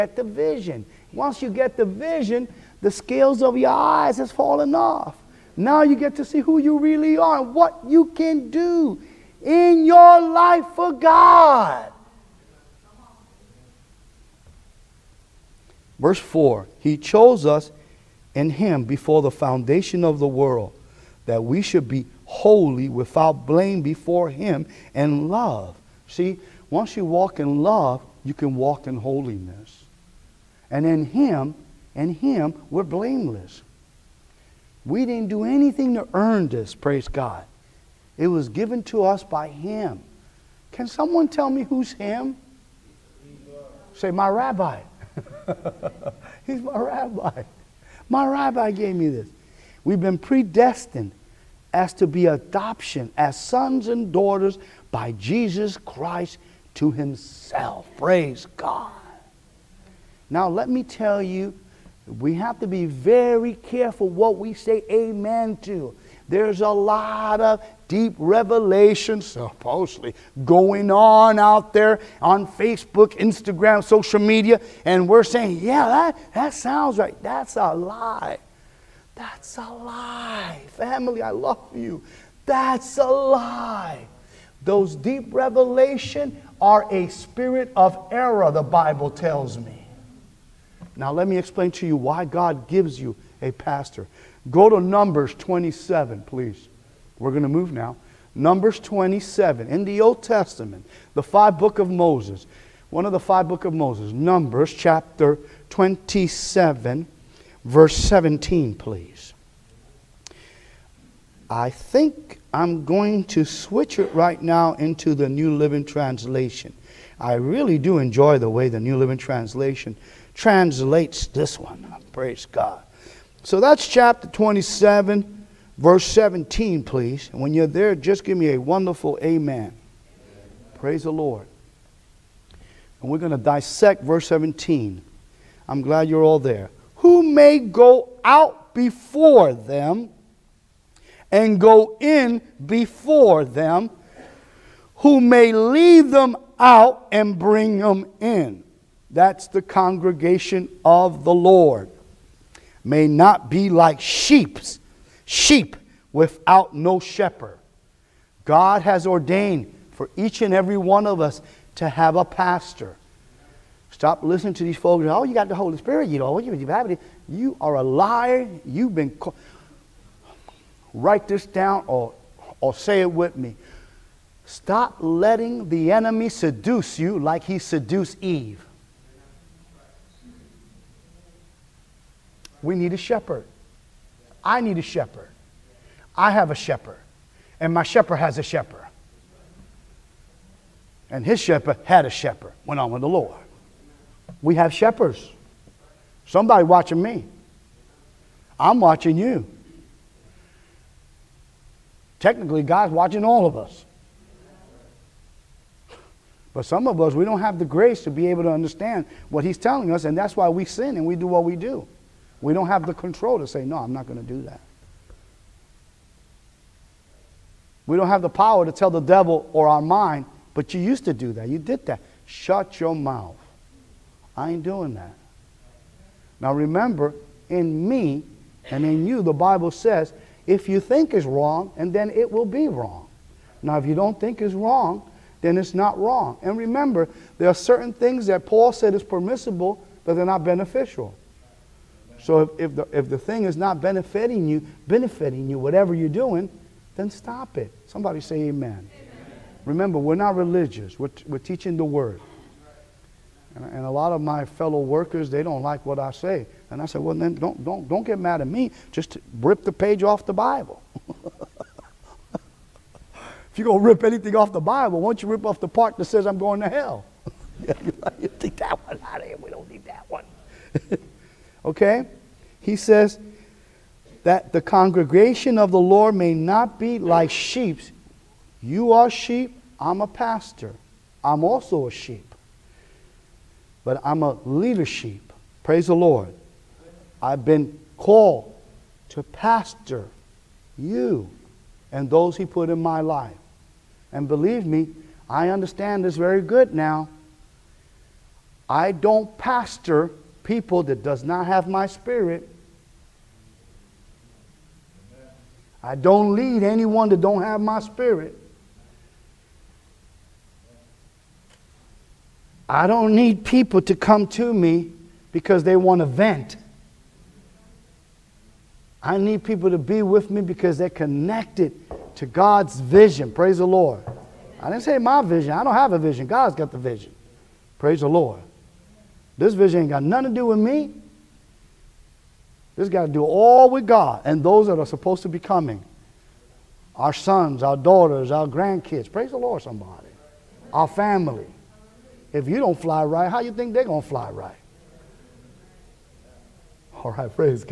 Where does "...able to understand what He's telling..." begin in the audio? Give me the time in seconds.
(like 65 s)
208 s.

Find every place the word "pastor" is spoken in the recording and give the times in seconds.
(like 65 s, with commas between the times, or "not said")
93 s, 162 s, 280 s, 289 s, 299 s.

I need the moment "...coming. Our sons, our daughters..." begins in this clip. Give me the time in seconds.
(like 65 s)
335 s.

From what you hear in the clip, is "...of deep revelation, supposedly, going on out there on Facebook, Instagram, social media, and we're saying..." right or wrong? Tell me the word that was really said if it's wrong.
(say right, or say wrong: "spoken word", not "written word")
right.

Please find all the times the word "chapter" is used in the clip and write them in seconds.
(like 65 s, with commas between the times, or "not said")
104 s, 123 s.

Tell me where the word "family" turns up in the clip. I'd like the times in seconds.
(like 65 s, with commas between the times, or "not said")
80 s, 340 s.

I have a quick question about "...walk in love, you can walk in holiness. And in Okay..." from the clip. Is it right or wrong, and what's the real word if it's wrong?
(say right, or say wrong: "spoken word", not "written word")
wrong: "Him", not "Okay".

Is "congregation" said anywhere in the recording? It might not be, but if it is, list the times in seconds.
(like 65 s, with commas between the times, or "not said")
149 s, 274 s.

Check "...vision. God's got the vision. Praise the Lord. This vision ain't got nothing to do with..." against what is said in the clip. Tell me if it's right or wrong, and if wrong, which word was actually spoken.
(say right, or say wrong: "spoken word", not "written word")
right.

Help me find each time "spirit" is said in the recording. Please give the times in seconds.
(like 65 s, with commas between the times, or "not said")
87 s, 165 s, 301 s, 307 s.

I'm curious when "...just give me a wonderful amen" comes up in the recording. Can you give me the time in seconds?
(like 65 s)
127 s.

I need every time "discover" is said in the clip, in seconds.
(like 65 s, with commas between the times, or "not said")
not said.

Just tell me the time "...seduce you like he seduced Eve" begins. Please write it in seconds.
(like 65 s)
176 s.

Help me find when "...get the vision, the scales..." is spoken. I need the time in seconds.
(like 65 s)
1 s.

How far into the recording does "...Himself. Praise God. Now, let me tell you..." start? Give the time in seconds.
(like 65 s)
56 s.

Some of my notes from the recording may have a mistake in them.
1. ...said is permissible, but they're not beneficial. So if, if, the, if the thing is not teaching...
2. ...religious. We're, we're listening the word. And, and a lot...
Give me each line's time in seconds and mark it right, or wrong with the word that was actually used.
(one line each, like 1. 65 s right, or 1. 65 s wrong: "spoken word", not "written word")
1. 238 s wrong: "benefiting", not "teaching"
2. 250 s wrong: "teaching", not "listening".